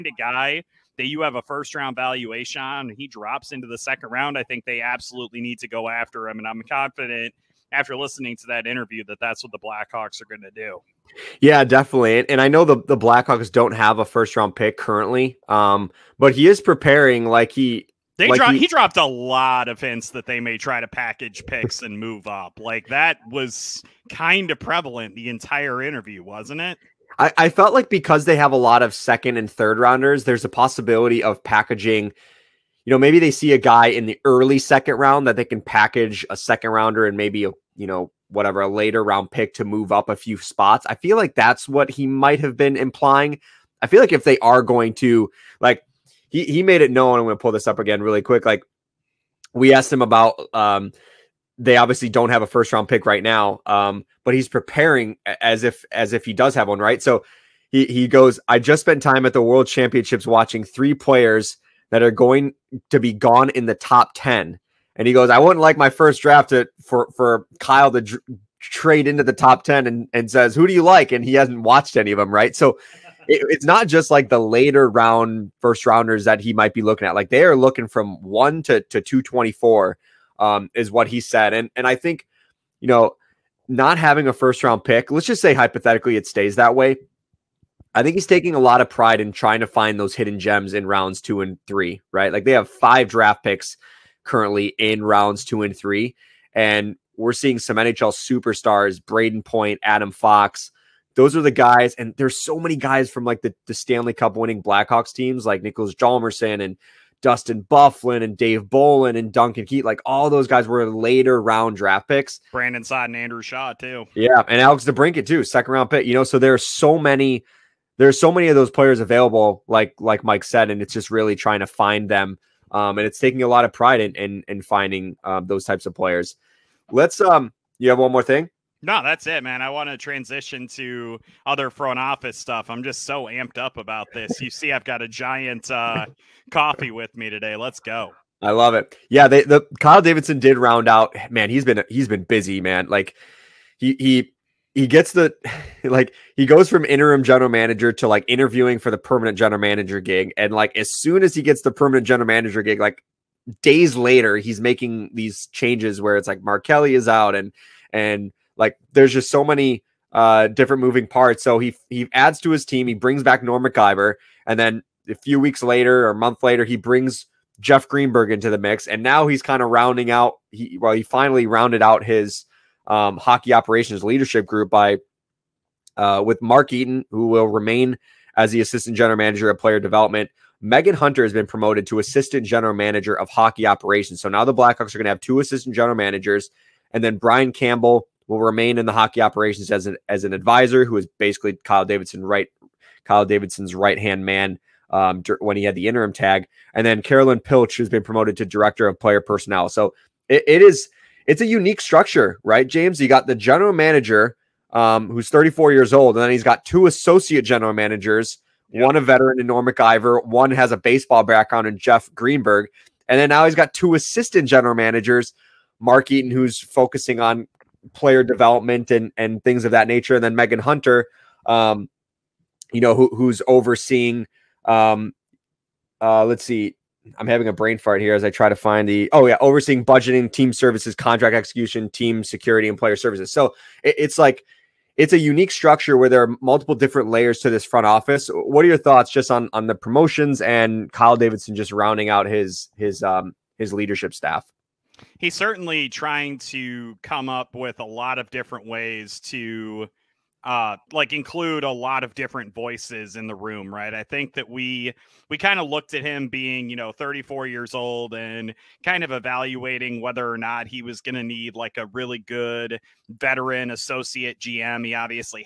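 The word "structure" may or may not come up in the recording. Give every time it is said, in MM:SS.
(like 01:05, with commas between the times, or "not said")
03:21, 03:55.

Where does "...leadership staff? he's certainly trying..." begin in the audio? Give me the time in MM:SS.
04:03.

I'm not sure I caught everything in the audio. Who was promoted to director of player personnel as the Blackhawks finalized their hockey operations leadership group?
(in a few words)
Carolyn Pilch.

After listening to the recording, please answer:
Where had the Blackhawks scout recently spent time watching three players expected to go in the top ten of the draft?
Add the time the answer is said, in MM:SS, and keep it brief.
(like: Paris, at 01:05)
World Championships, at 00:59.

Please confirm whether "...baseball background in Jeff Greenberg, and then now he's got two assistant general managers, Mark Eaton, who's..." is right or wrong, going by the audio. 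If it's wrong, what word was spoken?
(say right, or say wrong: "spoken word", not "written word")
right.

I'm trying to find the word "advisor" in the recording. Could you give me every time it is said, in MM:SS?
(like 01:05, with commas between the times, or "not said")
03:10.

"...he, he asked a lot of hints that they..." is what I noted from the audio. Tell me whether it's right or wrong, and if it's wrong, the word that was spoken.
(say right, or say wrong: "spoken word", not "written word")
wrong: "dropped", not "asked".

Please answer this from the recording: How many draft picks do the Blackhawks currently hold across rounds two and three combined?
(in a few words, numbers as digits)
5.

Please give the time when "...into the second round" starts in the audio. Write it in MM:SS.
00:03.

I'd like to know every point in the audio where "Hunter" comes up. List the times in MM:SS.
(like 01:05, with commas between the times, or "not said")
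03:00, 03:40.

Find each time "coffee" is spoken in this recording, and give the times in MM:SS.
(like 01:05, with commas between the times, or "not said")
02:16.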